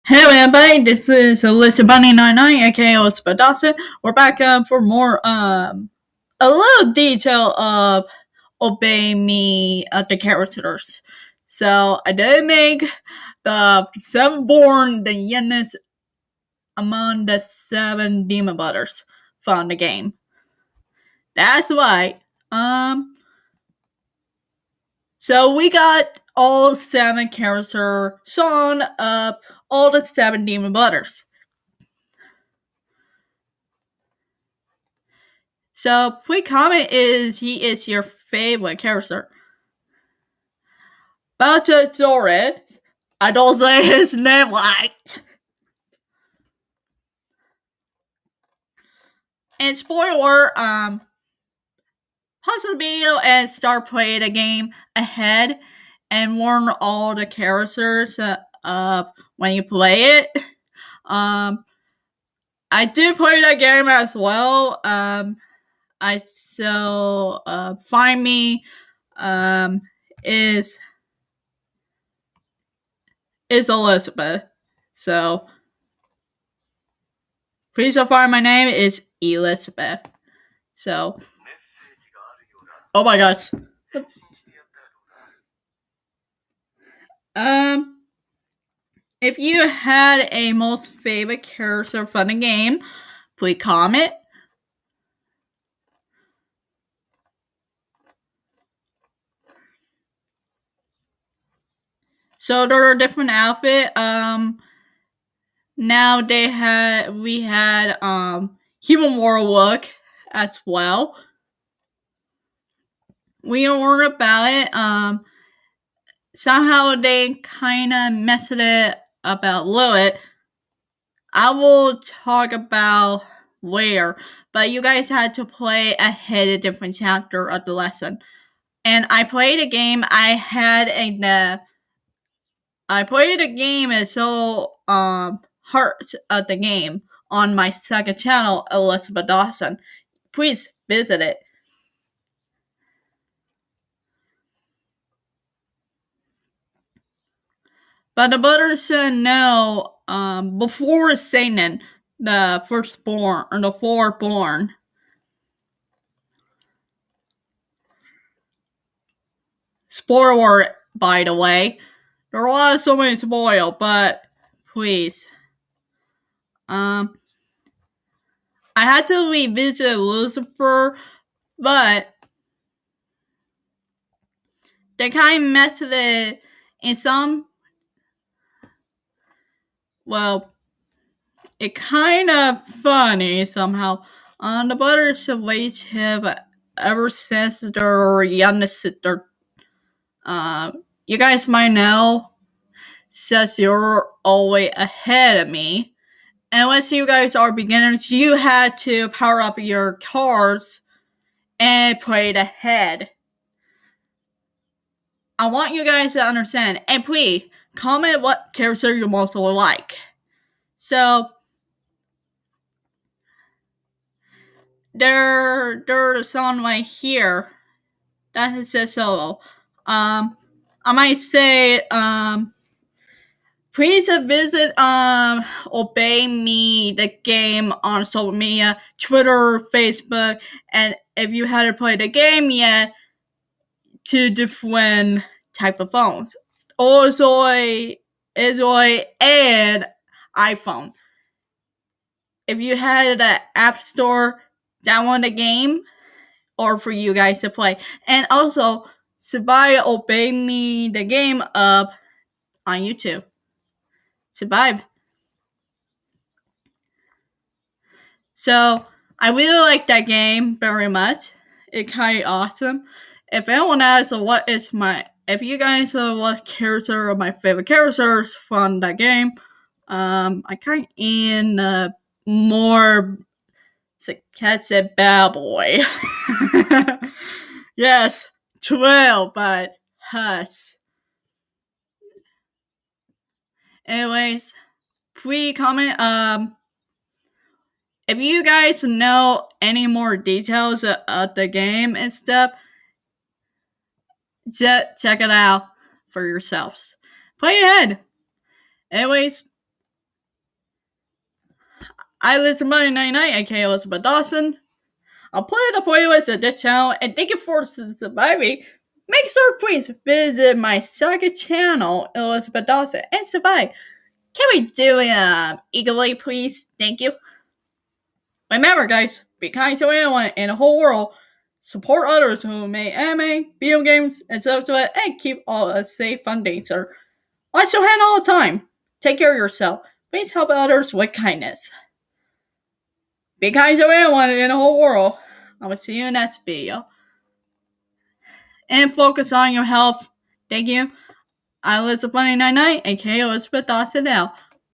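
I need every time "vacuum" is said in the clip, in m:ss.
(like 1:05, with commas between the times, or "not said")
not said.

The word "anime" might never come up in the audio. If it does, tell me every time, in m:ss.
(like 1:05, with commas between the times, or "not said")
5:22.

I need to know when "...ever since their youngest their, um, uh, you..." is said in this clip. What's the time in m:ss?
3:06.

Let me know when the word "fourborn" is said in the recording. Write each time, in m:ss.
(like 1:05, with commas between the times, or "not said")
2:33.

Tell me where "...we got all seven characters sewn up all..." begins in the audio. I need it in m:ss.
0:25.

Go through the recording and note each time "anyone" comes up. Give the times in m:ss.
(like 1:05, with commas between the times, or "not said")
4:23, 5:19.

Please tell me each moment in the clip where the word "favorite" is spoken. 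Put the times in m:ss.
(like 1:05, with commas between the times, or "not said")
0:38, 1:30, 4:27.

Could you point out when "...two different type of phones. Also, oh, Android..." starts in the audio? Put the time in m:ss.
3:54.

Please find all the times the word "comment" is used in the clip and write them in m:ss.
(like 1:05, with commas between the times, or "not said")
0:36, 1:33, 3:27, 4:45.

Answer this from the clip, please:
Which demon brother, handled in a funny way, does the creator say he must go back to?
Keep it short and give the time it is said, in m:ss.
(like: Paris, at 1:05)
Lucifer, at 2:49.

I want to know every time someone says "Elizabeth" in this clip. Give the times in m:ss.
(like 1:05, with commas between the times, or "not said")
1:13, 1:19, 2:18, 5:03, 5:12.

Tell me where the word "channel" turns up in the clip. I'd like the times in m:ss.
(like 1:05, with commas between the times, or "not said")
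2:18, 5:06, 5:11.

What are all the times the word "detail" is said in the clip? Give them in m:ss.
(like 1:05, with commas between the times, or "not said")
0:06, 4:50.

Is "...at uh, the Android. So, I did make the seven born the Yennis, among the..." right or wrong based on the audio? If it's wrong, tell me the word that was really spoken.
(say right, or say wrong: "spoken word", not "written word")
wrong: "Characters", not "Android".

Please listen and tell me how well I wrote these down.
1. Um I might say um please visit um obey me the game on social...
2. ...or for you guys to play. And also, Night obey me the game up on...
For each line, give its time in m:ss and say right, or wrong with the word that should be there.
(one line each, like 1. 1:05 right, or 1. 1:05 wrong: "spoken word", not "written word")
1. 3:39 right
2. 4:06 wrong: "Sabai", not "Night".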